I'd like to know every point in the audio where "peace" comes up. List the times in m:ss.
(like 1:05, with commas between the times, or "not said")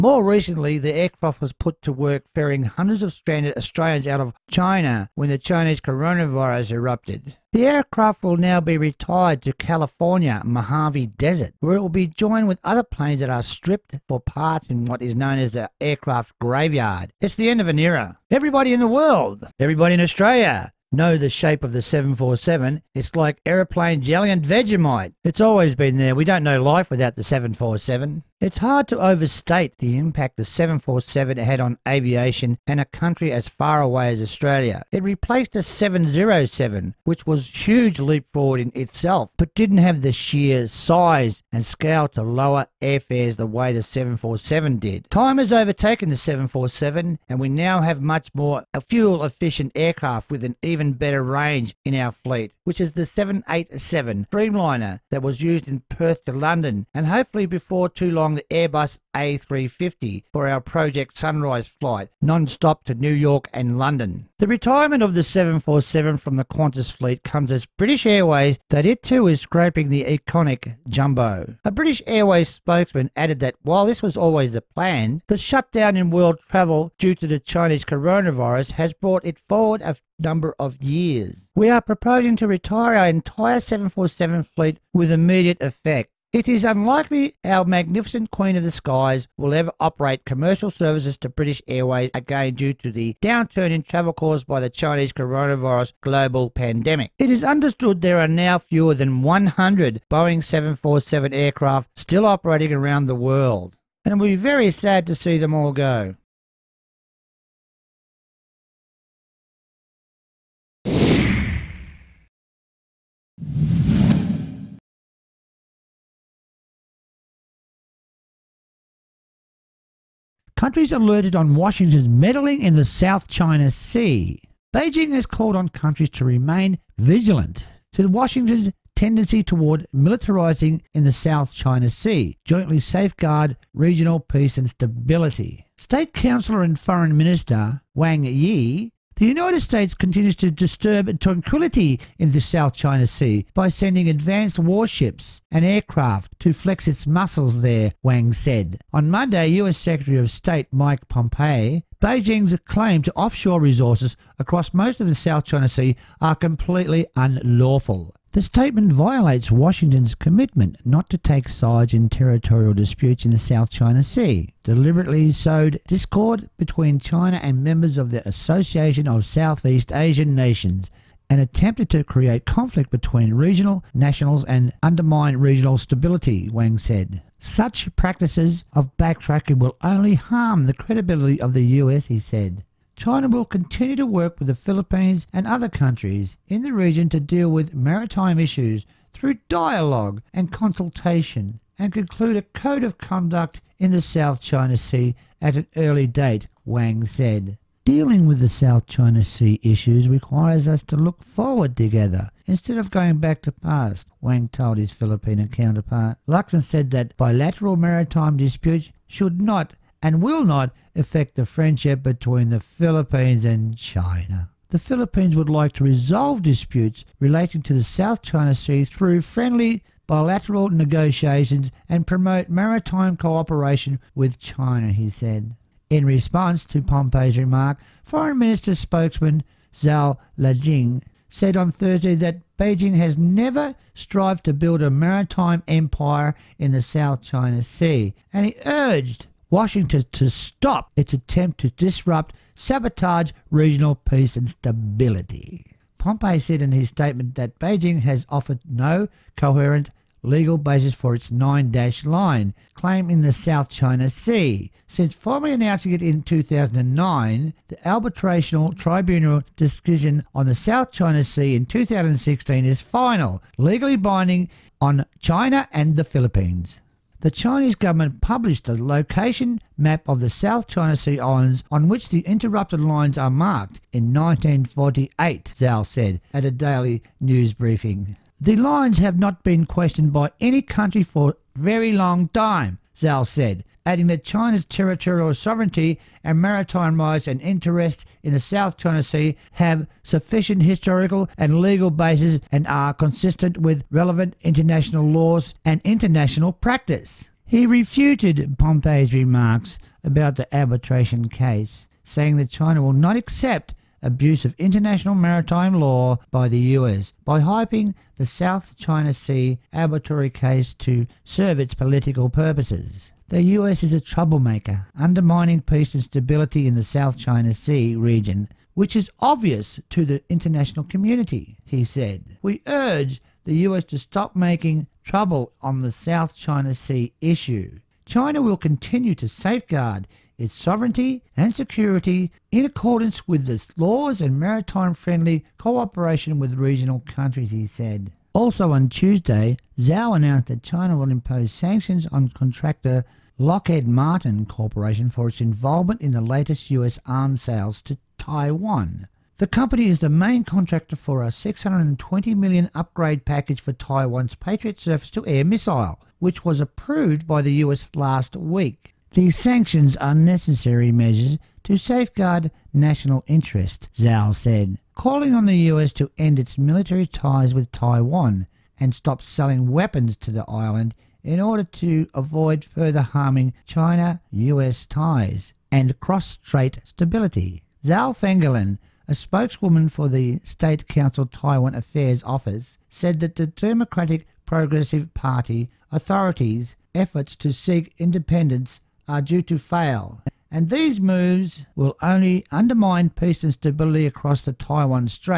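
2:14, 4:03, 5:15, 6:33.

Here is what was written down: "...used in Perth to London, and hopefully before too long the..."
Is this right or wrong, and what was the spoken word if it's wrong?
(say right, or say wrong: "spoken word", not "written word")
right.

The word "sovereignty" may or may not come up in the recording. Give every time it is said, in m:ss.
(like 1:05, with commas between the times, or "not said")
4:45, 5:30.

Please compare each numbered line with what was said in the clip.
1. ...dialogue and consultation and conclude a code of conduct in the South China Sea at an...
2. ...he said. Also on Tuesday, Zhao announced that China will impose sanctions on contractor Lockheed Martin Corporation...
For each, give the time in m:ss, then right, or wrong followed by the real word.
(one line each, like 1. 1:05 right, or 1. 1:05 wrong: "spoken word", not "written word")
1. 3:09 right
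2. 5:37 right.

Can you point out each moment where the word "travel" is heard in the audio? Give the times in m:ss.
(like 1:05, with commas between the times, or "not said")
1:16, 1:33.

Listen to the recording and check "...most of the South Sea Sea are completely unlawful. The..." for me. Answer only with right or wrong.
wrong.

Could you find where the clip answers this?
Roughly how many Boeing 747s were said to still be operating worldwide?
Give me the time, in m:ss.
1:38.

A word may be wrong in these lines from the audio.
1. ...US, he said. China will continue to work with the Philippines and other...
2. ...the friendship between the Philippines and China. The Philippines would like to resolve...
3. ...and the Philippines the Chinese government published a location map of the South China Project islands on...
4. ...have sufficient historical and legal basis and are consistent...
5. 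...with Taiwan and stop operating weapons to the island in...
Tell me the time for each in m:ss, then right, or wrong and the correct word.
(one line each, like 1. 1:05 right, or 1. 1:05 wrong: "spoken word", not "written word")
1. 3:01 right
2. 3:31 right
3. 4:25 wrong: "Sea", not "Project"
4. 4:49 right
5. 6:07 wrong: "selling", not "operating".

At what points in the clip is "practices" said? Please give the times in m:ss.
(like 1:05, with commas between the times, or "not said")
2:57, 4:56.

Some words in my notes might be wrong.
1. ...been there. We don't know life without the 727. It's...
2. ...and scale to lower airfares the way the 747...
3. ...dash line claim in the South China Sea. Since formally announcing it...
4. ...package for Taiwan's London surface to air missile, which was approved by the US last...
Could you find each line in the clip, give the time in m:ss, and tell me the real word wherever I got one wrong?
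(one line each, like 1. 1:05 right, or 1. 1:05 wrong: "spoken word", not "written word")
1. 0:25 wrong: "747", not "727"
2. 0:41 right
3. 4:11 right
4. 5:53 wrong: "Patriot", not "London".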